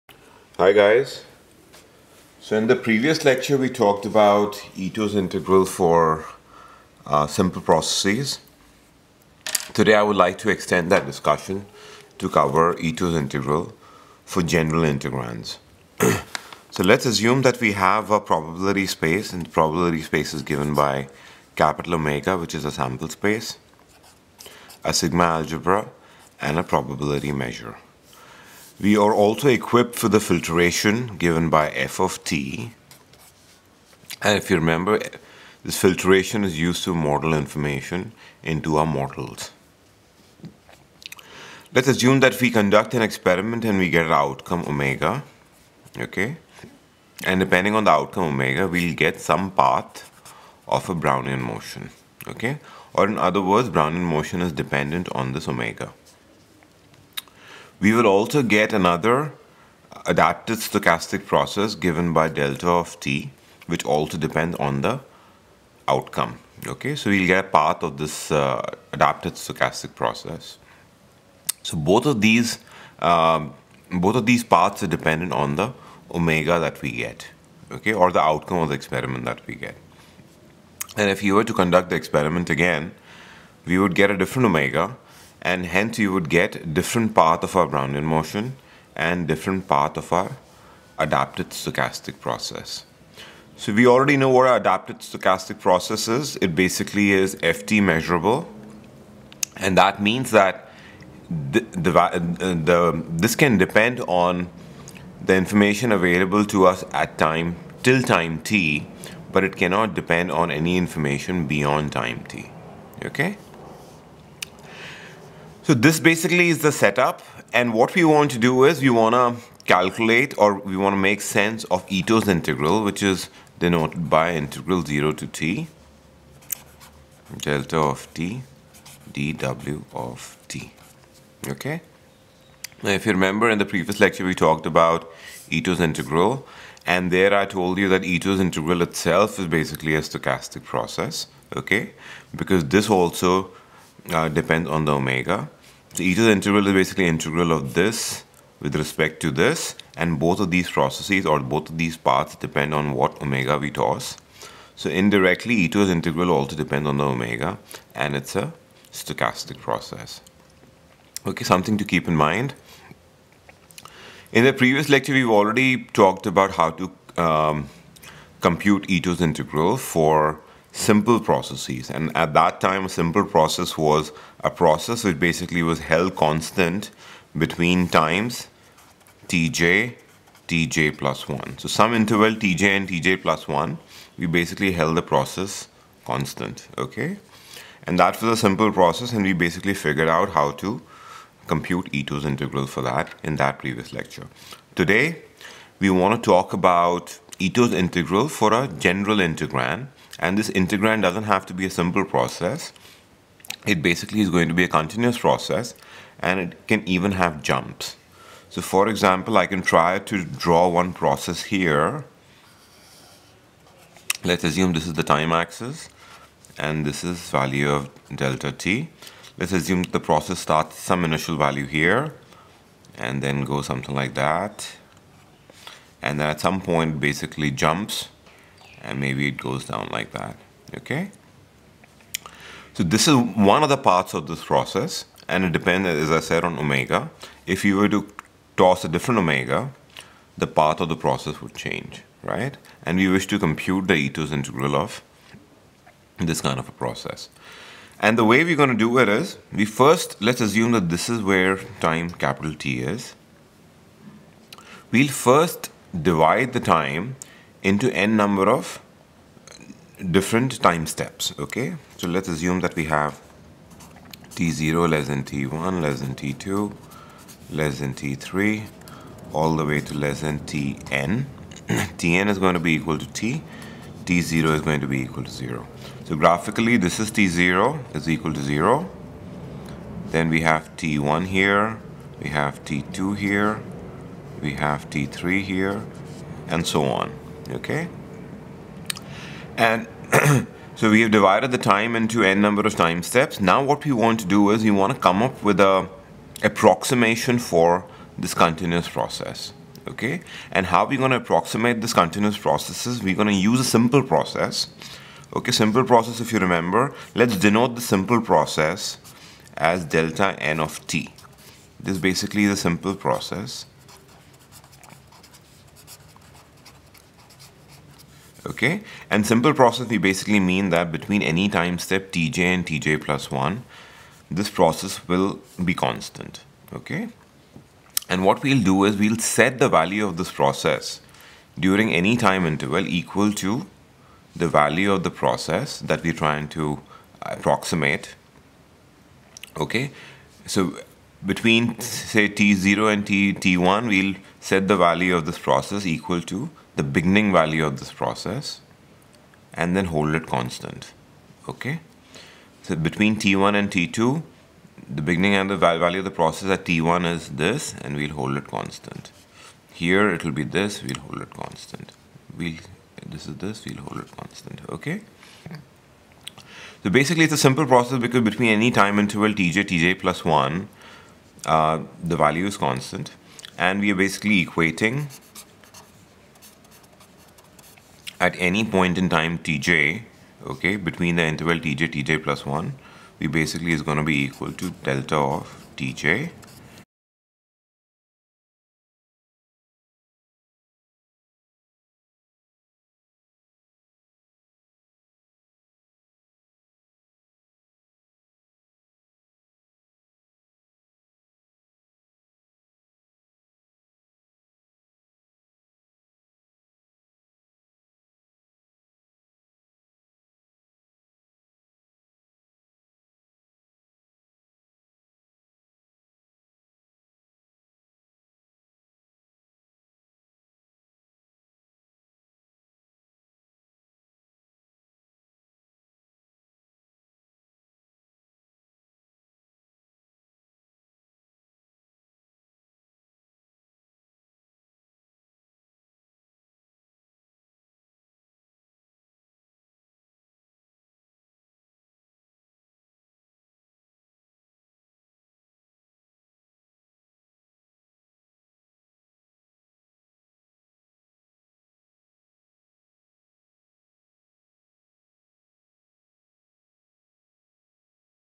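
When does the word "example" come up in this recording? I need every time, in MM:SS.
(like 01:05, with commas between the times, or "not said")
03:28.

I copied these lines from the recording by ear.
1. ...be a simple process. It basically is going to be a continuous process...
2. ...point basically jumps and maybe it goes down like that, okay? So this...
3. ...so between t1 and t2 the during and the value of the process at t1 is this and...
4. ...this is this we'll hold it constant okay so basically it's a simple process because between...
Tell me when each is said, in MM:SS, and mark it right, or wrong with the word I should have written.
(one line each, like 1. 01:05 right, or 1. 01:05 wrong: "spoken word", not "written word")
1. 03:21 right
2. 03:46 right
3. 05:52 wrong: "beginning", not "during"
4. 06:03 right.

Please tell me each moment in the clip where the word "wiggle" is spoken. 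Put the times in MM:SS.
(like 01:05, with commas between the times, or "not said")
not said.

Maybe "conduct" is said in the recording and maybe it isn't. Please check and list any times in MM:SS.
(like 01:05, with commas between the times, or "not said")
00:42, 01:21.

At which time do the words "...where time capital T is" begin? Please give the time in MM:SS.
04:11.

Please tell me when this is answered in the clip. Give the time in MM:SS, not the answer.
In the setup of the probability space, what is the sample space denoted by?
00:21.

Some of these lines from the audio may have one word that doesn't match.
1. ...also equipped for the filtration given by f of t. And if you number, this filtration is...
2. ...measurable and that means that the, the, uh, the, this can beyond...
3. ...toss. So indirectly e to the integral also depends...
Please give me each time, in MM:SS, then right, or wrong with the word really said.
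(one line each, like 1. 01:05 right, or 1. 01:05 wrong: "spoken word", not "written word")
1. 00:29 wrong: "remember", not "number"
2. 01:37 wrong: "depend", not "beyond"
3. 02:33 right.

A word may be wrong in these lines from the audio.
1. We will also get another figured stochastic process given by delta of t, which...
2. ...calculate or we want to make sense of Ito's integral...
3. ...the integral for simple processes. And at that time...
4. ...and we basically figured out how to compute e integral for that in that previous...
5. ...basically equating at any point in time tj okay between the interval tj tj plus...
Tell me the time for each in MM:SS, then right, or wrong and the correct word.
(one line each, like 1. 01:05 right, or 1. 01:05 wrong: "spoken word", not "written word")
1. 00:57 wrong: "adapted", not "figured"
2. 01:59 right
3. 02:49 right
4. 03:09 right
5. 06:13 right.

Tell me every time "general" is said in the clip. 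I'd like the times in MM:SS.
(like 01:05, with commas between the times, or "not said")
00:14, 03:18.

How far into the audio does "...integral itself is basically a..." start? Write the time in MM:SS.
02:18.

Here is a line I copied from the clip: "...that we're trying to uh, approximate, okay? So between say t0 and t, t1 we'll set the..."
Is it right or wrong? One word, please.
right.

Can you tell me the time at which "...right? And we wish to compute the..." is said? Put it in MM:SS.
04:02.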